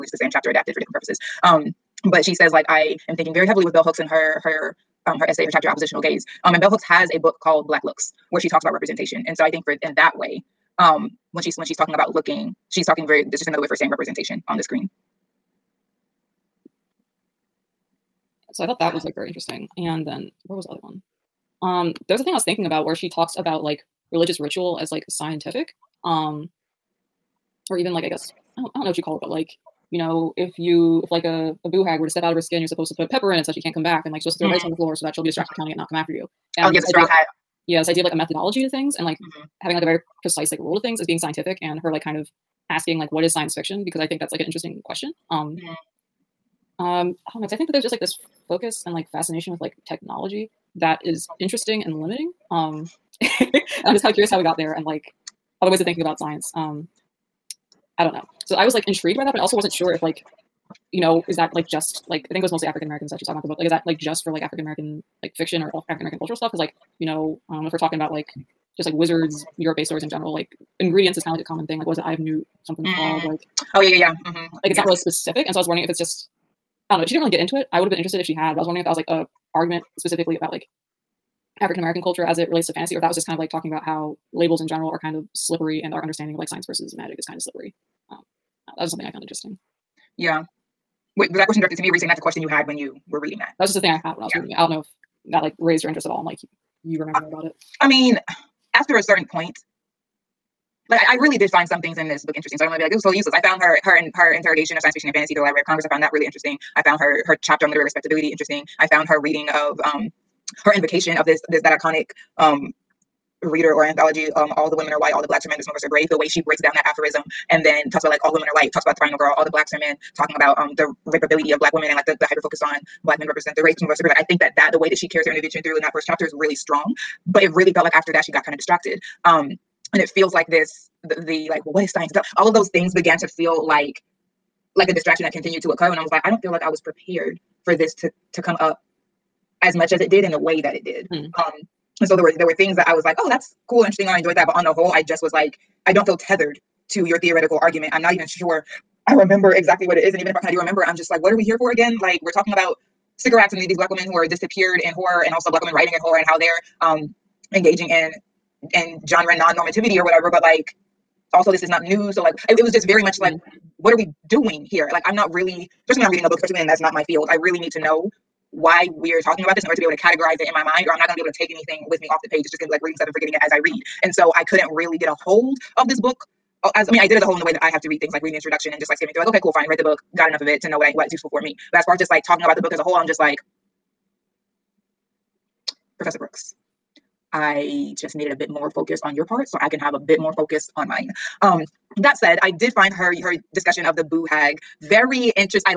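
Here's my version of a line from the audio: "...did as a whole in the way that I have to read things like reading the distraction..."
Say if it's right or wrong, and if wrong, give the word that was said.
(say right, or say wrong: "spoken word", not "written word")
wrong: "introduction", not "distraction".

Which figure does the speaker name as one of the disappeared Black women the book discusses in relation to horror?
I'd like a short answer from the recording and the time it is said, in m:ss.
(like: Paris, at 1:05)
Sycorax, at 2:33.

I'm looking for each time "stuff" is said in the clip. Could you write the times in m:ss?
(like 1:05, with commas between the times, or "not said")
1:06, 2:52.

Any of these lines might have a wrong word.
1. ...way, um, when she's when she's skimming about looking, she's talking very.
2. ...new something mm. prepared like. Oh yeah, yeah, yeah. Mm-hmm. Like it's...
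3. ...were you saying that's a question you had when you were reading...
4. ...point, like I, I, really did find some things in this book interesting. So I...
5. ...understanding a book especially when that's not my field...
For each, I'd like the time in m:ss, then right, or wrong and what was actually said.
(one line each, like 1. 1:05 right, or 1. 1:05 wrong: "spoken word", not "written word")
1. 0:10 wrong: "talking", not "skimming"
2. 1:12 wrong: "called", not "prepared"
3. 1:31 right
4. 1:39 right
5. 2:46 wrong: "reading", not "understanding".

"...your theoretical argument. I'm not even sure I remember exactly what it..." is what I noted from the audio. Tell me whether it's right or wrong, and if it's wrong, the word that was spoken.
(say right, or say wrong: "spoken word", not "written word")
right.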